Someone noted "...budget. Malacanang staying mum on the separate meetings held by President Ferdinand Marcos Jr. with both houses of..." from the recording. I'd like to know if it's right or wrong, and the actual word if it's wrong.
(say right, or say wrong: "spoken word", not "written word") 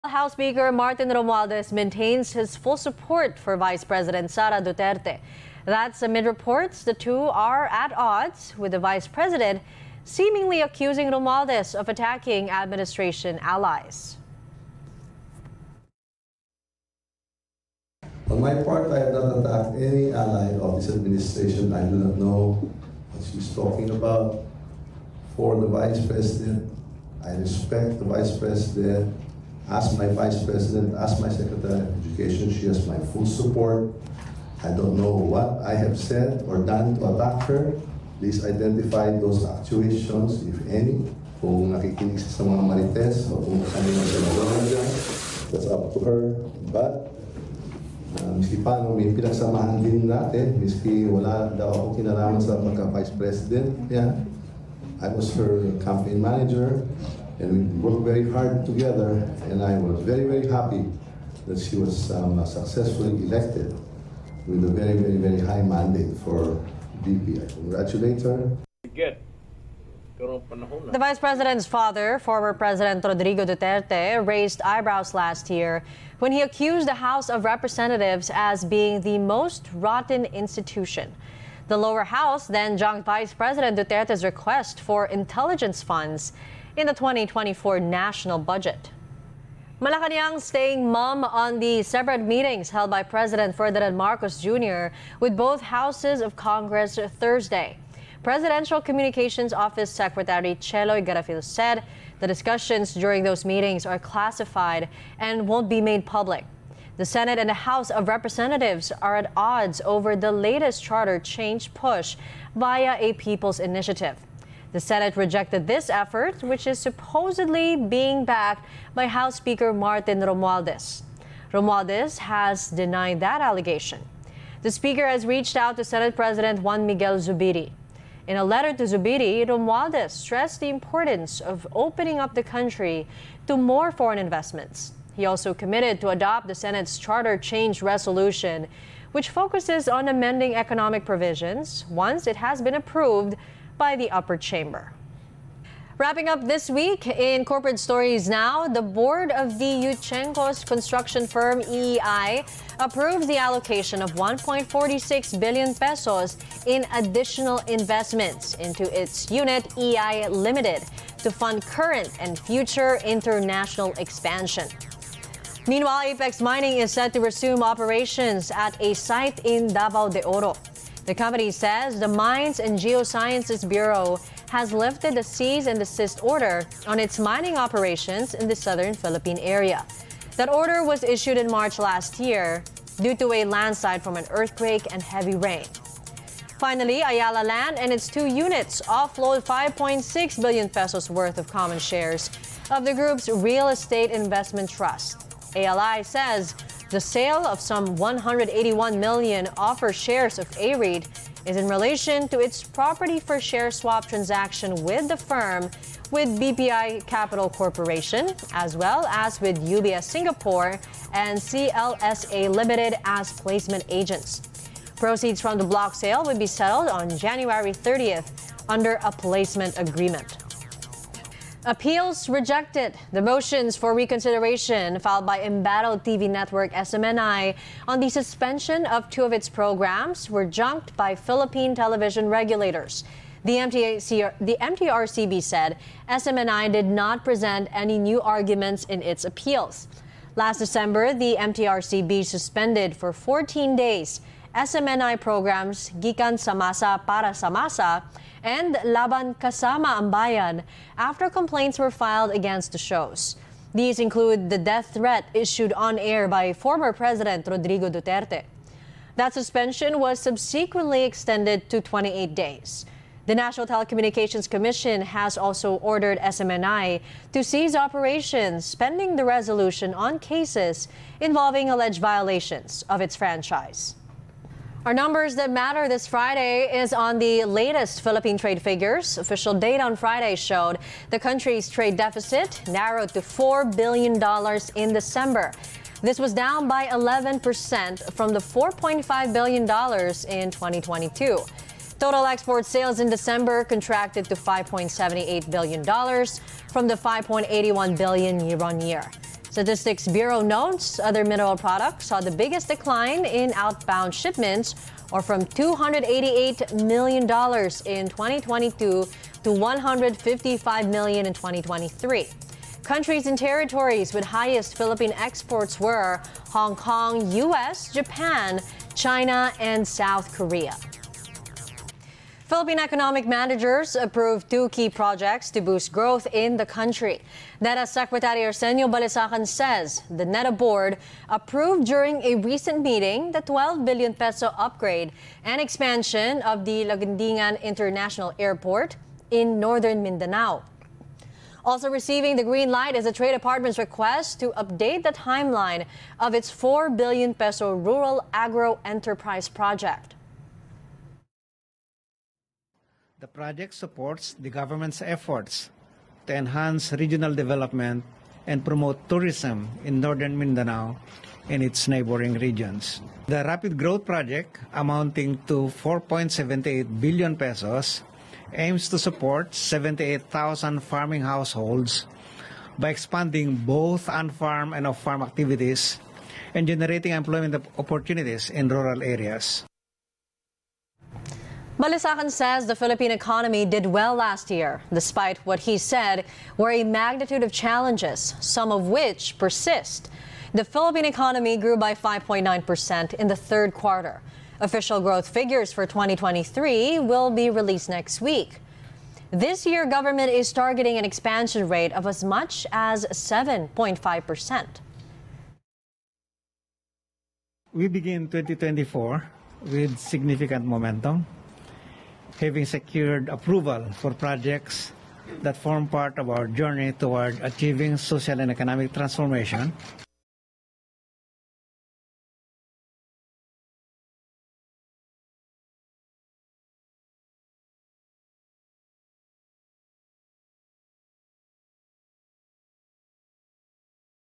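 right.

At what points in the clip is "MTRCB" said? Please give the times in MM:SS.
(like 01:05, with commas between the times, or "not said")
03:54, 04:01.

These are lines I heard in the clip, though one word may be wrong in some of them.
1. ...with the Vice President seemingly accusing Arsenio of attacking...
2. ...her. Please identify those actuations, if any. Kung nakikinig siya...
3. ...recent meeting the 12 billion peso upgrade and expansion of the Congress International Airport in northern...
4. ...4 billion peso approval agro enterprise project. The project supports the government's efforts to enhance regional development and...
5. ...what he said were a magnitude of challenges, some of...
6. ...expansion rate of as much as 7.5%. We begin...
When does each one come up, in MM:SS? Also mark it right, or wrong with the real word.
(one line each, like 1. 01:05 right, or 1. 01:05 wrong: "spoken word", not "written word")
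1. 00:08 wrong: "Romualdez", not "Arsenio"
2. 00:37 right
3. 05:32 wrong: "Laguindingan", not "Congress"
4. 05:46 wrong: "rural", not "approval"
5. 06:25 right
6. 06:41 right.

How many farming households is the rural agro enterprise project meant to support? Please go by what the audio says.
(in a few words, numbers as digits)
78,000.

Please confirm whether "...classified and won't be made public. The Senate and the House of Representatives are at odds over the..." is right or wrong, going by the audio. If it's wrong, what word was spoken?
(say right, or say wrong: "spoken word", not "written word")
right.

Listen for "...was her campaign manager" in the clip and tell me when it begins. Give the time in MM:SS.
00:55.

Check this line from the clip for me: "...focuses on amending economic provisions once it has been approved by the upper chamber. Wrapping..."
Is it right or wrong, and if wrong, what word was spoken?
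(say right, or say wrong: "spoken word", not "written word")
right.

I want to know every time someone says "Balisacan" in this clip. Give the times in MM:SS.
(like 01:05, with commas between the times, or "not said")
05:28, 06:21.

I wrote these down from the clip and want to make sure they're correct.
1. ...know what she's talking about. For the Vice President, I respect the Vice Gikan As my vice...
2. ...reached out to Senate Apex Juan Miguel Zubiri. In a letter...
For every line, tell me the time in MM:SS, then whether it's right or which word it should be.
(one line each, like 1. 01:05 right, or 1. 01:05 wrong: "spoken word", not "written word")
1. 00:22 wrong: "President", not "Gikan"
2. 02:05 wrong: "President", not "Apex".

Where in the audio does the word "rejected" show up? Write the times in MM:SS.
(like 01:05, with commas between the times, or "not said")
01:55, 03:42.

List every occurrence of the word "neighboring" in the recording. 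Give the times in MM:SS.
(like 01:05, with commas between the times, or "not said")
06:01.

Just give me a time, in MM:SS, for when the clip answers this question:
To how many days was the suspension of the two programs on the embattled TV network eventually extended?
04:21.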